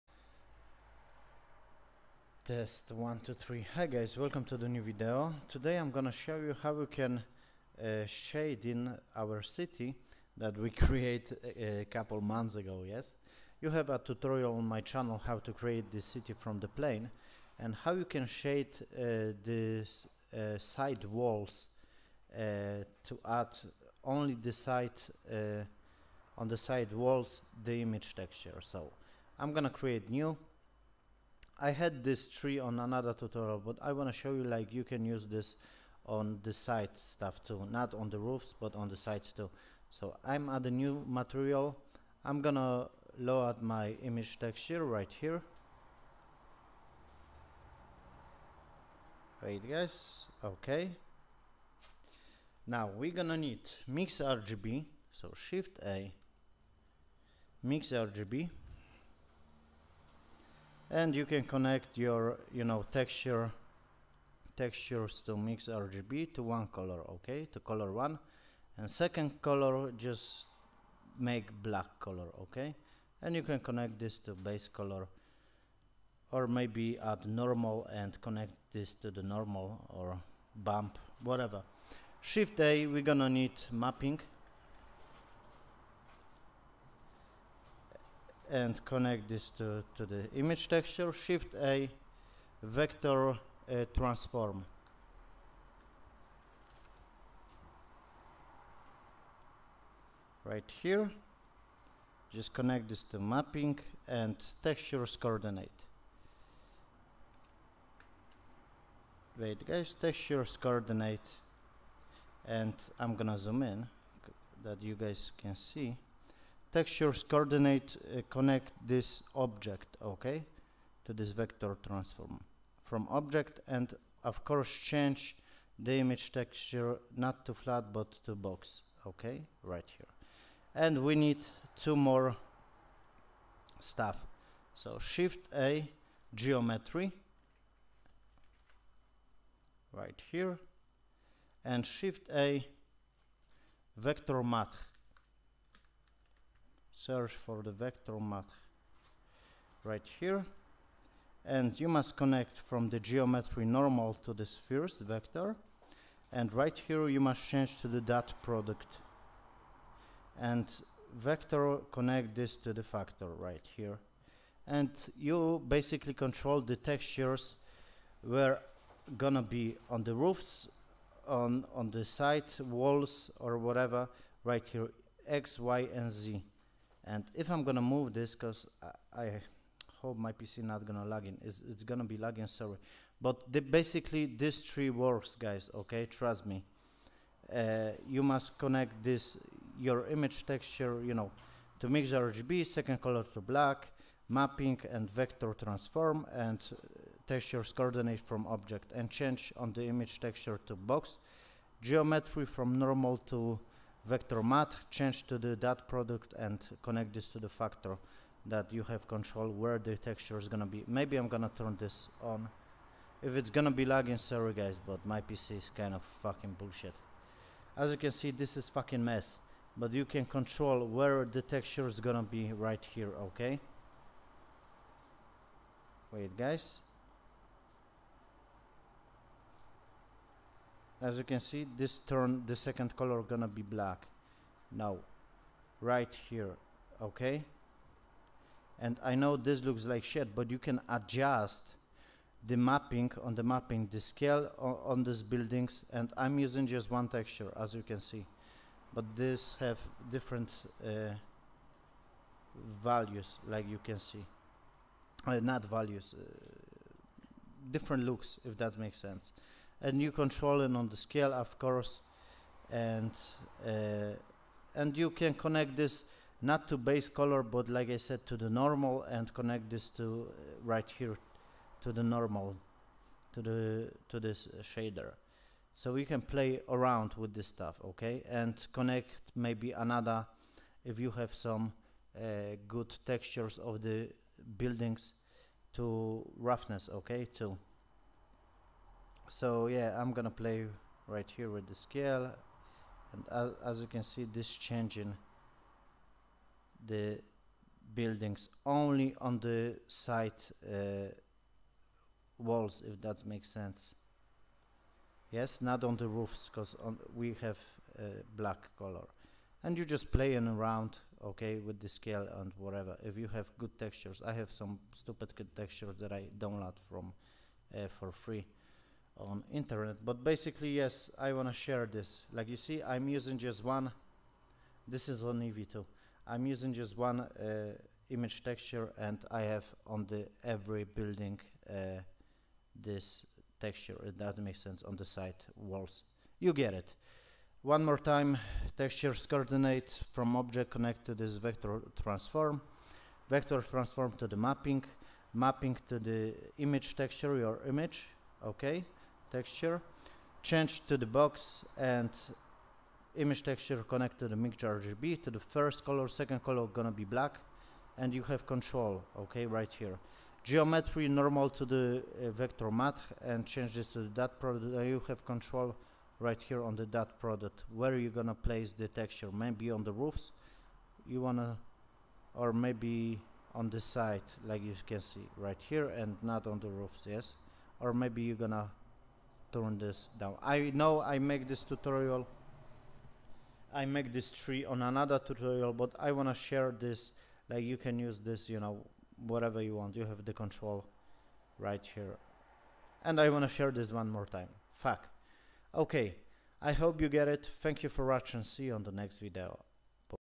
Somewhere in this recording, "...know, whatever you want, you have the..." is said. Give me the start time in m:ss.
6:28.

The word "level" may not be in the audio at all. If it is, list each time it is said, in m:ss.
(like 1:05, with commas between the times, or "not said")
not said.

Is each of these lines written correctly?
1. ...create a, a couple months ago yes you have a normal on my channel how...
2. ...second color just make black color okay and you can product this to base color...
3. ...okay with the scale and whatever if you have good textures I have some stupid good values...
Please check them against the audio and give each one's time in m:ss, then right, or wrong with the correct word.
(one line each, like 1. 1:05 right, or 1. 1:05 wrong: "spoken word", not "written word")
1. 0:10 wrong: "tutorial", not "normal"
2. 1:08 wrong: "connect", not "product"
3. 5:11 wrong: "textures", not "values".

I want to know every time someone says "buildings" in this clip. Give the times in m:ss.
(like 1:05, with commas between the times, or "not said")
4:05, 4:44, 4:57, 5:30.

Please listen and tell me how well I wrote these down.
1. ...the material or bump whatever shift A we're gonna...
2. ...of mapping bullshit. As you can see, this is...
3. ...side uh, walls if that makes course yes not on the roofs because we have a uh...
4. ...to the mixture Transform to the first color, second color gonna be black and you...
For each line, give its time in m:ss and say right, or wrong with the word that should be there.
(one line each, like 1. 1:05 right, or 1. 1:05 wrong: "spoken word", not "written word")
1. 1:19 wrong: "normal", not "material"
2. 3:35 wrong: "fucking", not "mapping"
3. 4:59 wrong: "sense", not "course"
4. 5:54 wrong: "RGB", not "Transform".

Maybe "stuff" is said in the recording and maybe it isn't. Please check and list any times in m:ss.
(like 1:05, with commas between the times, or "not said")
0:36, 2:13, 4:37.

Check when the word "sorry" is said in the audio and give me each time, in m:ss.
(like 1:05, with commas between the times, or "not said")
3:02, 3:34.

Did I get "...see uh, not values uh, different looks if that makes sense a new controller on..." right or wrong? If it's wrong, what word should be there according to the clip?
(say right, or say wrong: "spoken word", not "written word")
right.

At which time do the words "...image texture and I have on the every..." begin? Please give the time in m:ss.
5:28.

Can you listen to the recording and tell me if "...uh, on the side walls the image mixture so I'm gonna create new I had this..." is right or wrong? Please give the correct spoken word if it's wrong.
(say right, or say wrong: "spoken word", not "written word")
wrong: "texture", not "mixture".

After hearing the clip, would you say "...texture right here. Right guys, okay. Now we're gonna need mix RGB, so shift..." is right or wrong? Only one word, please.
right.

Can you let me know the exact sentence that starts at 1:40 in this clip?
Right here, just connect this to mapping and textures coordinate.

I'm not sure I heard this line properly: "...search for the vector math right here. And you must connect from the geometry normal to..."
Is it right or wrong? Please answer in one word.
right.